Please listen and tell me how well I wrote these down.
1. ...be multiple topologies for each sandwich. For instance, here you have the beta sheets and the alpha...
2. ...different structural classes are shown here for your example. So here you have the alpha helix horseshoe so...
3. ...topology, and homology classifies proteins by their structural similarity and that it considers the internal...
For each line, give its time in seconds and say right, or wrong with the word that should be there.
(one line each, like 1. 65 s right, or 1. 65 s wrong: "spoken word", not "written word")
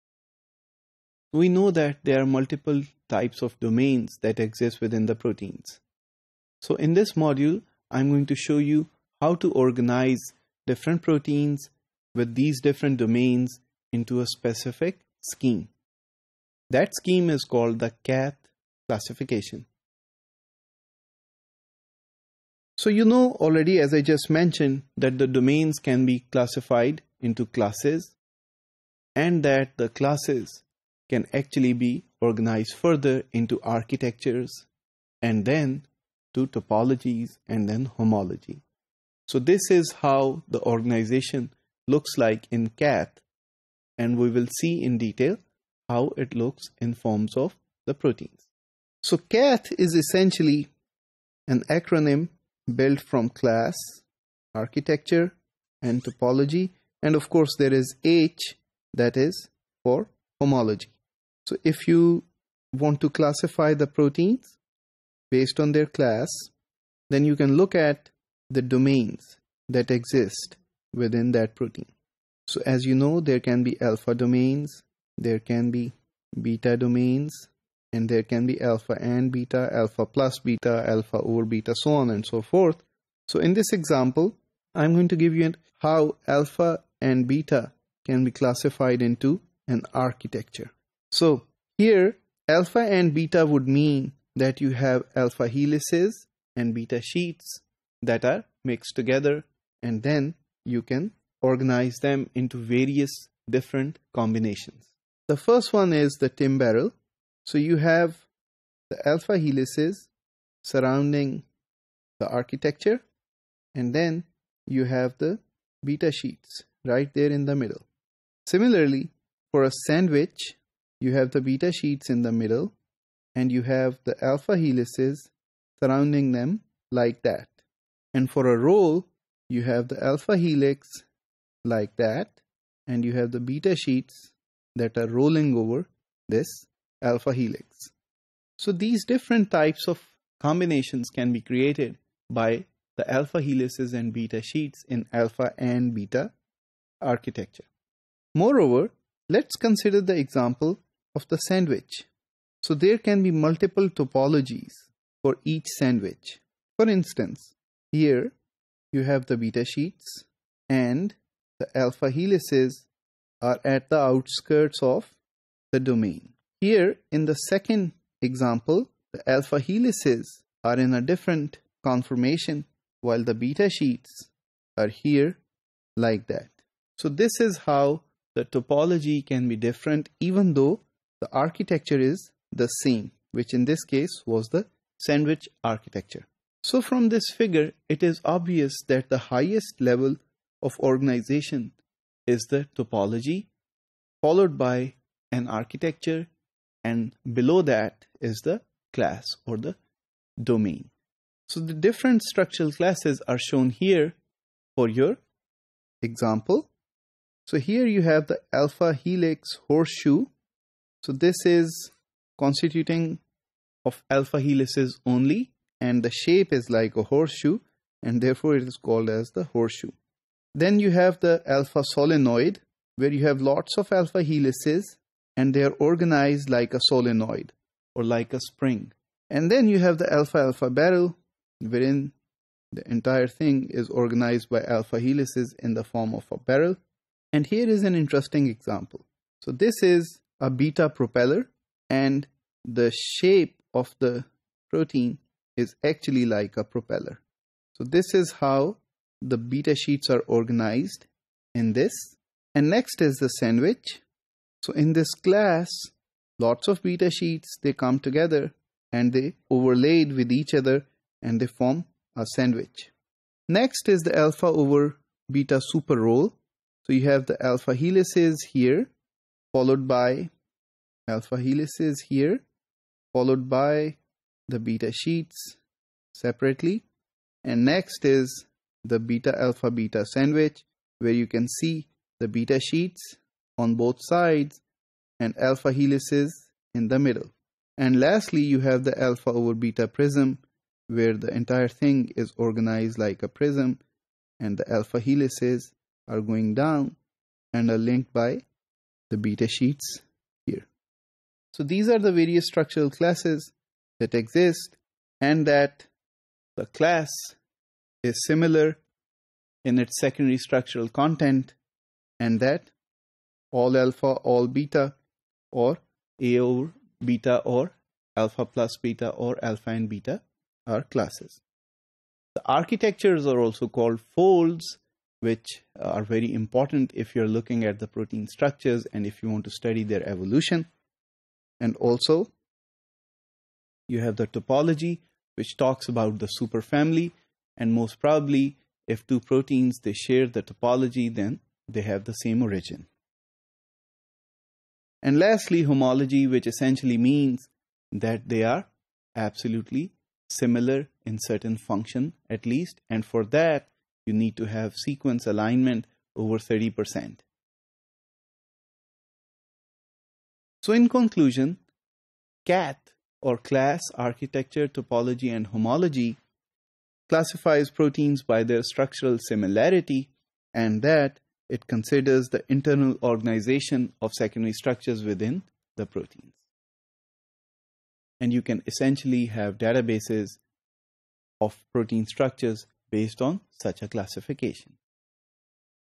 1. 153 s right
2. 201 s right
3. 364 s right.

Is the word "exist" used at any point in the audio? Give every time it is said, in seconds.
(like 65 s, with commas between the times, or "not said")
4 s, 69 s, 304 s.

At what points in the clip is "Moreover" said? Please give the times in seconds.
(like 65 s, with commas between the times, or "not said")
148 s.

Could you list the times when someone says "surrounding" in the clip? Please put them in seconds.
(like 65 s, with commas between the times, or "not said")
110 s, 125 s.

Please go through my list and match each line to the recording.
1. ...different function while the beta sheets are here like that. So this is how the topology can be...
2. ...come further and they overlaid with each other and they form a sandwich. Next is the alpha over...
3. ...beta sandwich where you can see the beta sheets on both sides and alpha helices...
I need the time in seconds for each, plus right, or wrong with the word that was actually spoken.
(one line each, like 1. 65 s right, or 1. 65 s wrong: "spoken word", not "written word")
1. 171 s wrong: "conformation", not "function"
2. 257 s wrong: "together", not "further"
3. 279 s right.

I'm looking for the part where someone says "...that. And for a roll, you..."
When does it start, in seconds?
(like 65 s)
127 s.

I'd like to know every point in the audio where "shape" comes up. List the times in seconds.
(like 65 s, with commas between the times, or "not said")
216 s, 242 s.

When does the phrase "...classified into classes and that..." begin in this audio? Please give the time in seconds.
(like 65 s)
26 s.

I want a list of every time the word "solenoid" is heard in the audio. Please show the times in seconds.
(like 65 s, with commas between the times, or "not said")
221 s, 226 s.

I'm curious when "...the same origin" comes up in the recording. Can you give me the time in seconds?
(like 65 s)
342 s.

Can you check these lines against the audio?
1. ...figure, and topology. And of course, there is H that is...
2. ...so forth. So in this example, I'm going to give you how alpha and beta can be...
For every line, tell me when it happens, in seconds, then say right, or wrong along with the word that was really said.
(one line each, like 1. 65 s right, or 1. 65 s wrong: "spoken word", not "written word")
1. 54 s wrong: "architecture", not "figure"
2. 82 s right.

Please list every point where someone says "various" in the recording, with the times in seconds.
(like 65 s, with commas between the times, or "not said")
102 s, 302 s.